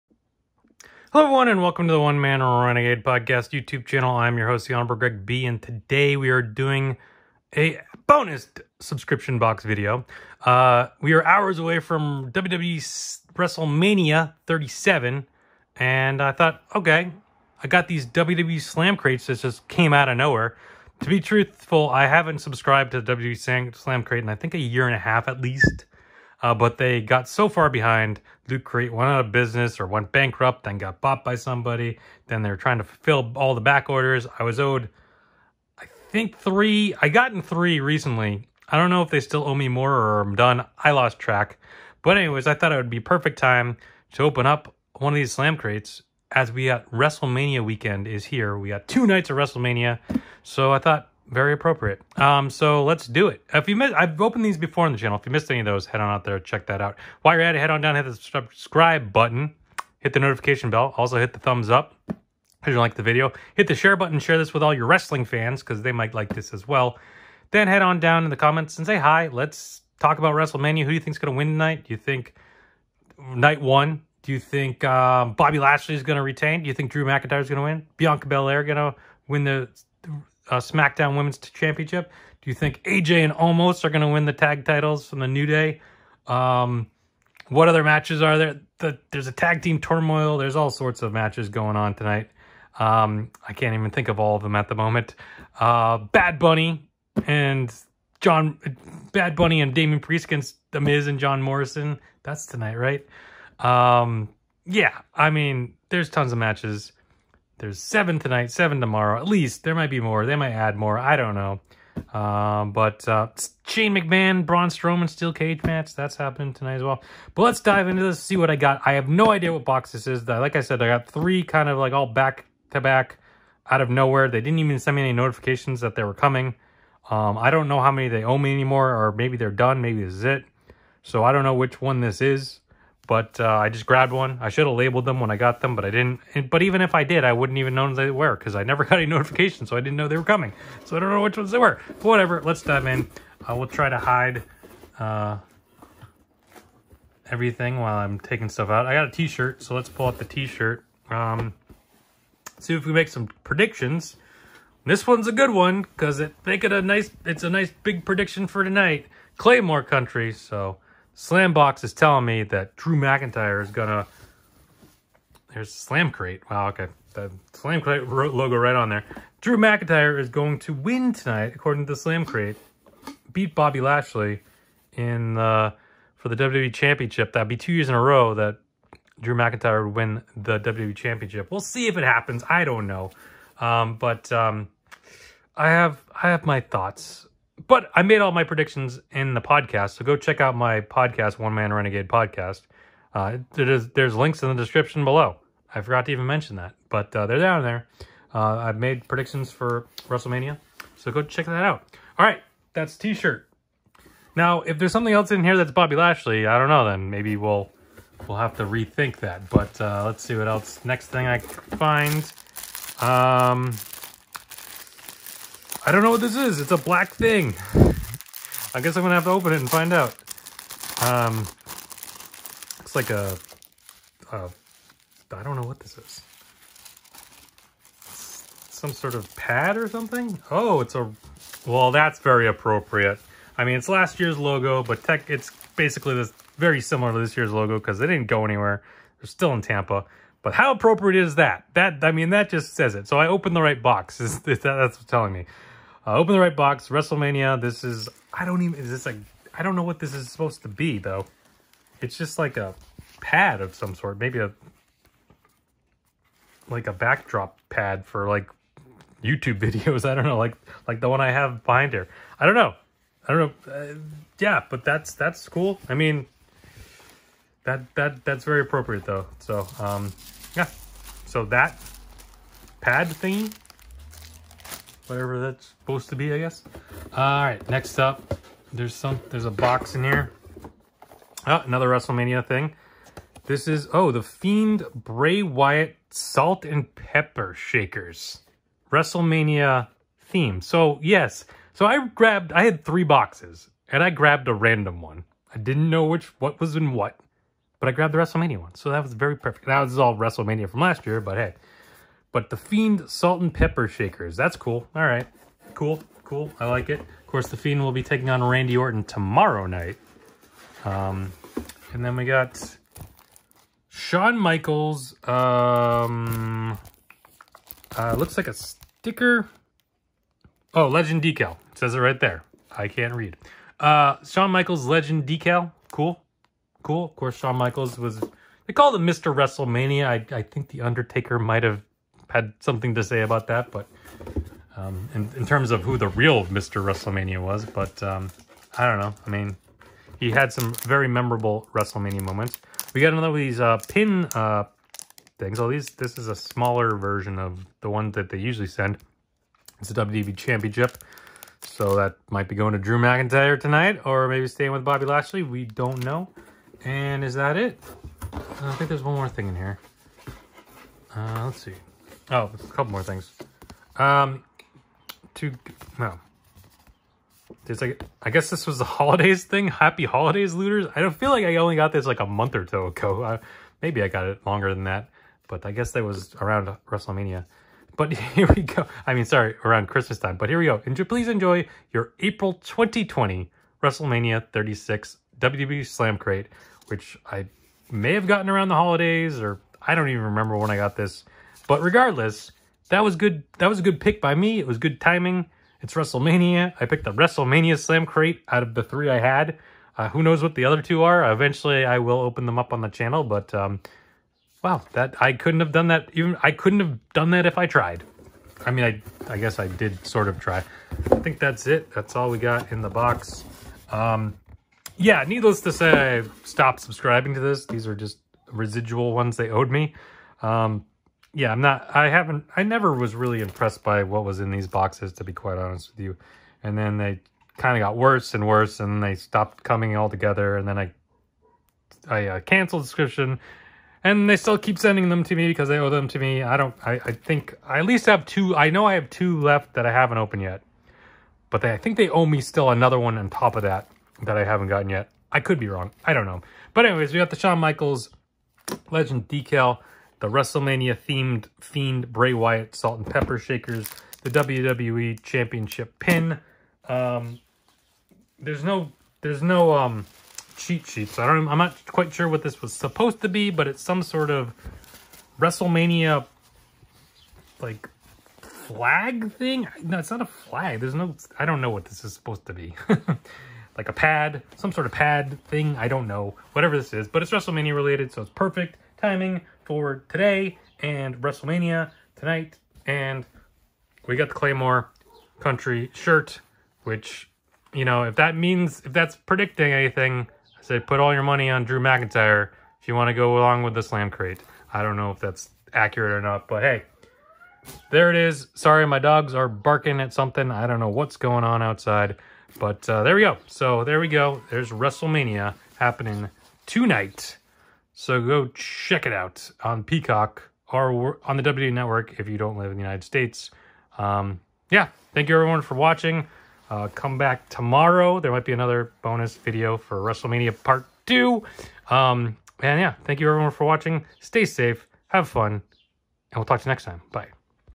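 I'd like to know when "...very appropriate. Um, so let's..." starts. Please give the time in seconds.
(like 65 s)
51 s.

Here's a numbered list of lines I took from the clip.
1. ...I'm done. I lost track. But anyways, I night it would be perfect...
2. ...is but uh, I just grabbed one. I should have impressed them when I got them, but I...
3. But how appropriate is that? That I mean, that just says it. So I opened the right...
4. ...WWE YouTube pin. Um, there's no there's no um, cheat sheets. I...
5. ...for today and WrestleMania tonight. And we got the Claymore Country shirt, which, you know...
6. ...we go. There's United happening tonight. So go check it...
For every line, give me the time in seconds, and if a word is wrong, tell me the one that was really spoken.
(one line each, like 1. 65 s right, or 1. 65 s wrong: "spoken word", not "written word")
1. 40 s wrong: "thought", not "night"
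2. 132 s wrong: "labeled", not "impressed"
3. 240 s right
4. 454 s wrong: "Championship", not "YouTube"
5. 479 s right
6. 503 s wrong: "WrestleMania", not "United".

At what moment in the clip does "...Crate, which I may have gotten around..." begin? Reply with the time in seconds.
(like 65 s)
386 s.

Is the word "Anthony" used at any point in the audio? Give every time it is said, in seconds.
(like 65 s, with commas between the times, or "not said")
not said.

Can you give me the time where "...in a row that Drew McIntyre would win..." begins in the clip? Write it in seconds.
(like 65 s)
177 s.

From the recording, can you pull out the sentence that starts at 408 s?
I mean, I I guess I did sort of try.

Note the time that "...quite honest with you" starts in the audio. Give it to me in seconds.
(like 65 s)
425 s.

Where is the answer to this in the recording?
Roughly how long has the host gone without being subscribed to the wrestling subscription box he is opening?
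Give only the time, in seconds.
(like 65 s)
24 s.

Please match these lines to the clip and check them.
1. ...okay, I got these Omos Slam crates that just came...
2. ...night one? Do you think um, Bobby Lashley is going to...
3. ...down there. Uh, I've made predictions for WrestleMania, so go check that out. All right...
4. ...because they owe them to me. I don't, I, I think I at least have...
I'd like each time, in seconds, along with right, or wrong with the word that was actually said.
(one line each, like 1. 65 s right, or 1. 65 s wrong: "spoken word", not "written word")
1. 16 s wrong: "WWE", not "Omos"
2. 73 s right
3. 197 s right
4. 435 s right.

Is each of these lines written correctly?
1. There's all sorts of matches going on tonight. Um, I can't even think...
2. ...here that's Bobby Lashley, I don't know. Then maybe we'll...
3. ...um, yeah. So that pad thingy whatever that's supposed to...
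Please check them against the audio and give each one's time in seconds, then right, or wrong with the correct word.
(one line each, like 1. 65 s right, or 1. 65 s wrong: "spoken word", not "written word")
1. 90 s right
2. 205 s right
3. 269 s right.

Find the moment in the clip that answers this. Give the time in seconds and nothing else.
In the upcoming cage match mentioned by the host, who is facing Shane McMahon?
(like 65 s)
114 s.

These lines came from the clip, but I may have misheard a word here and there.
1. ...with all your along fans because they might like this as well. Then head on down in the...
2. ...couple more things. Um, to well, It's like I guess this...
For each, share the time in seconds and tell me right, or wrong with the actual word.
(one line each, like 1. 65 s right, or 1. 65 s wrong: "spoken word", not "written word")
1. 64 s wrong: "wrestling", not "along"
2. 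362 s right.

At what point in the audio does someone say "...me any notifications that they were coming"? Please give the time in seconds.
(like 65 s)
124 s.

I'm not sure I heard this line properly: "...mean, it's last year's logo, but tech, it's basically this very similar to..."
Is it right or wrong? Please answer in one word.
right.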